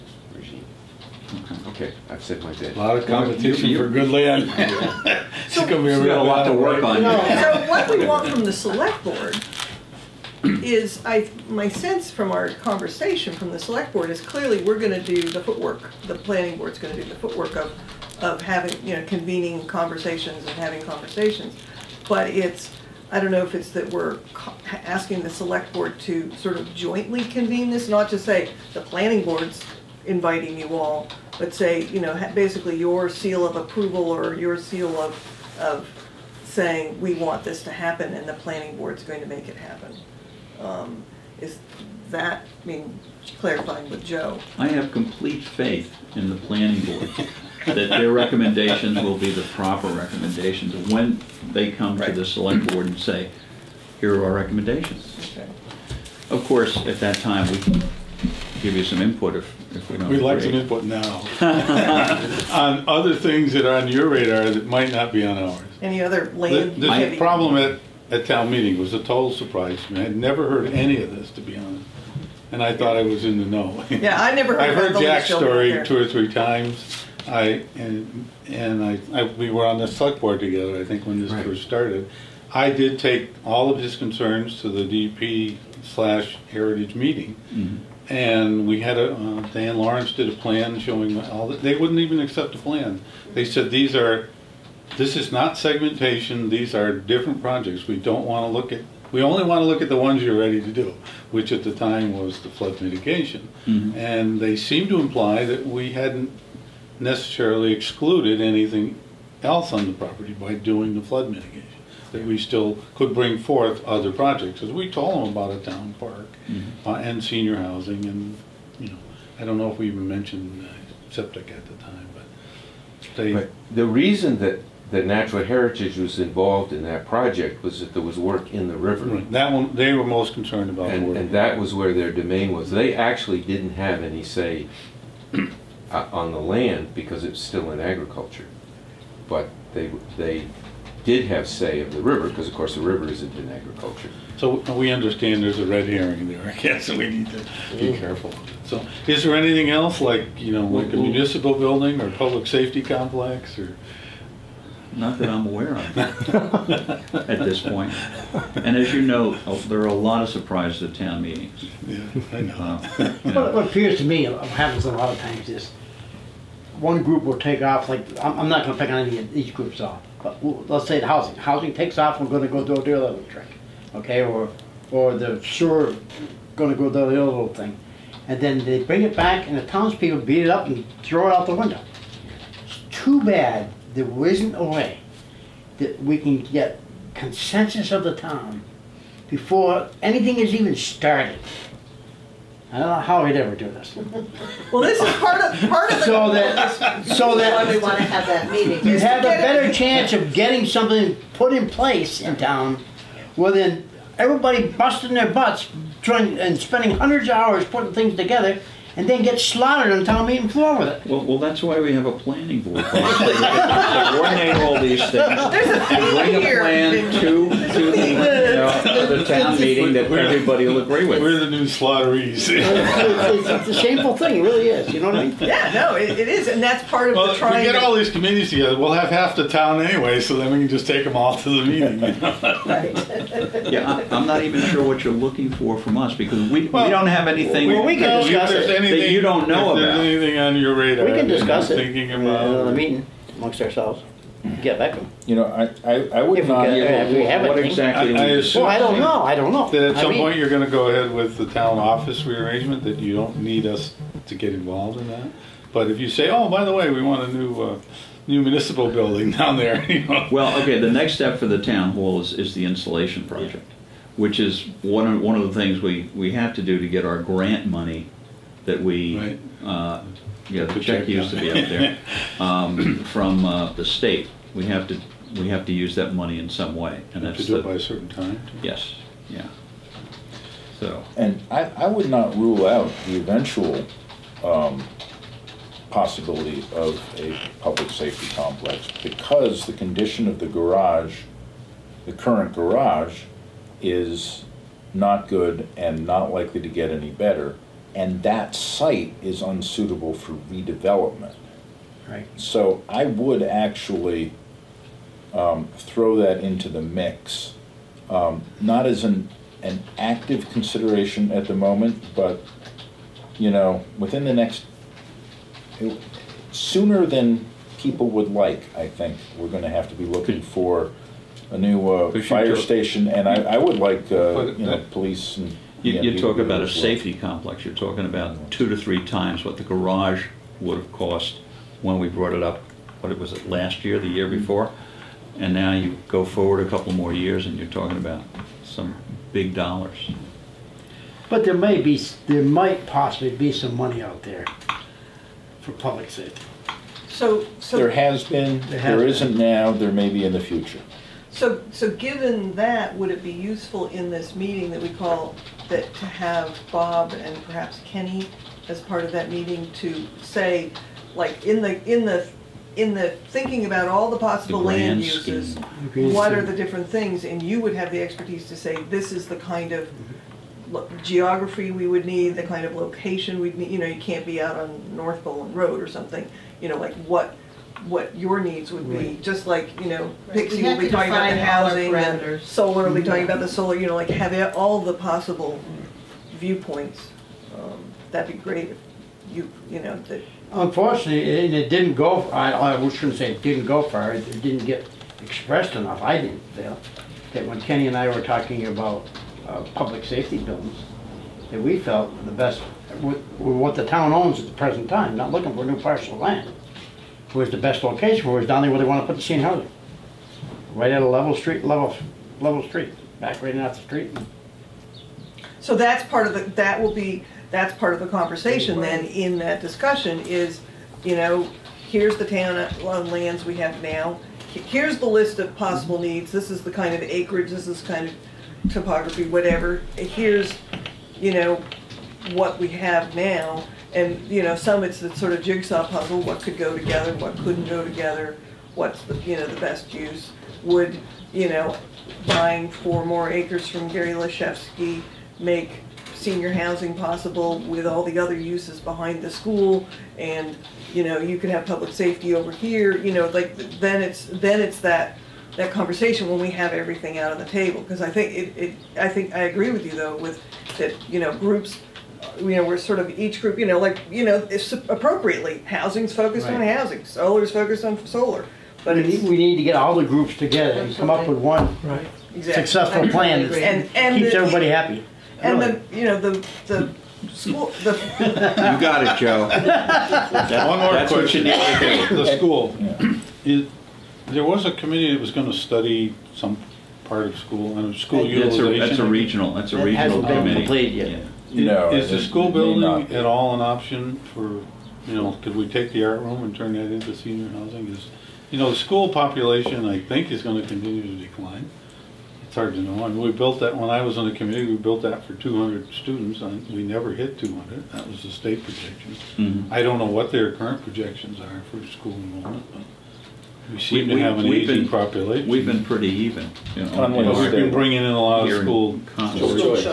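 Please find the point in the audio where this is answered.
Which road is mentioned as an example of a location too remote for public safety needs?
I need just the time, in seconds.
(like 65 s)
374 s.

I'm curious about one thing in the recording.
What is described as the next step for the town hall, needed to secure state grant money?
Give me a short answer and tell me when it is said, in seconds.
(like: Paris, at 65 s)
installation project, at 262 s.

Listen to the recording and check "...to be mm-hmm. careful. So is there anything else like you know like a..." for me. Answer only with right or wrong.
right.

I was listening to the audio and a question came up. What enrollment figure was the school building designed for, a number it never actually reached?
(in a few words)
200 students.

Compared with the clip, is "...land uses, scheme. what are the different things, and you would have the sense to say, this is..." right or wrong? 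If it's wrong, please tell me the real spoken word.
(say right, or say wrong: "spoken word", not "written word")
wrong: "expertise", not "sense".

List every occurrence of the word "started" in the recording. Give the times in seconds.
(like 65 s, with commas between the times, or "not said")
81 s, 190 s.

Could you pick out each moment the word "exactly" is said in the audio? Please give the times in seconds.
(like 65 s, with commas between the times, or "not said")
247 s, 472 s.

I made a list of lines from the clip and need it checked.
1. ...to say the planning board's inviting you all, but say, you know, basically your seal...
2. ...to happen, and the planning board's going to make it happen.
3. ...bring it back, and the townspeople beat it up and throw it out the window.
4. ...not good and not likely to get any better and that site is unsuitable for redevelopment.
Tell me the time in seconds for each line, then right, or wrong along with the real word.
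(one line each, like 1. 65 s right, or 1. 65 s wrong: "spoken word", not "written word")
1. 28 s right
2. 37 s right
3. 178 s right
4. 294 s right.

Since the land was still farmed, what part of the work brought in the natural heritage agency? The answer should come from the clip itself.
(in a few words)
work in the river.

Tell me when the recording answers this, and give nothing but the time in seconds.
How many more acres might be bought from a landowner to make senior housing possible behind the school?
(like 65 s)
442 s.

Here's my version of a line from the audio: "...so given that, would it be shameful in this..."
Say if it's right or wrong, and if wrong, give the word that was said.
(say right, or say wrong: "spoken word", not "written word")
wrong: "useful", not "shameful".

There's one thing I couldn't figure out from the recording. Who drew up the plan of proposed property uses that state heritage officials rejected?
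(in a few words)
Dan Lawrence.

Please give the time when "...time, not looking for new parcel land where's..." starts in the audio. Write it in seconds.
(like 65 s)
404 s.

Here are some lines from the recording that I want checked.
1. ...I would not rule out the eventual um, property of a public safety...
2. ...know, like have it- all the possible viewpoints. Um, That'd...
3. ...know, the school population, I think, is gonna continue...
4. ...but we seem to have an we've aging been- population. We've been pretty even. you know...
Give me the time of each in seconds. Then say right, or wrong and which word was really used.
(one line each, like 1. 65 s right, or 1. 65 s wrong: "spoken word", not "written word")
1. 281 s wrong: "possibility", not "property"
2. 383 s right
3. 498 s right
4. 512 s right.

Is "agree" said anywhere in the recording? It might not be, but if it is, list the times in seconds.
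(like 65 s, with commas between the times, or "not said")
220 s, 459 s.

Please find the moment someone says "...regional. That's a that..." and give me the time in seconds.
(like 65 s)
489 s.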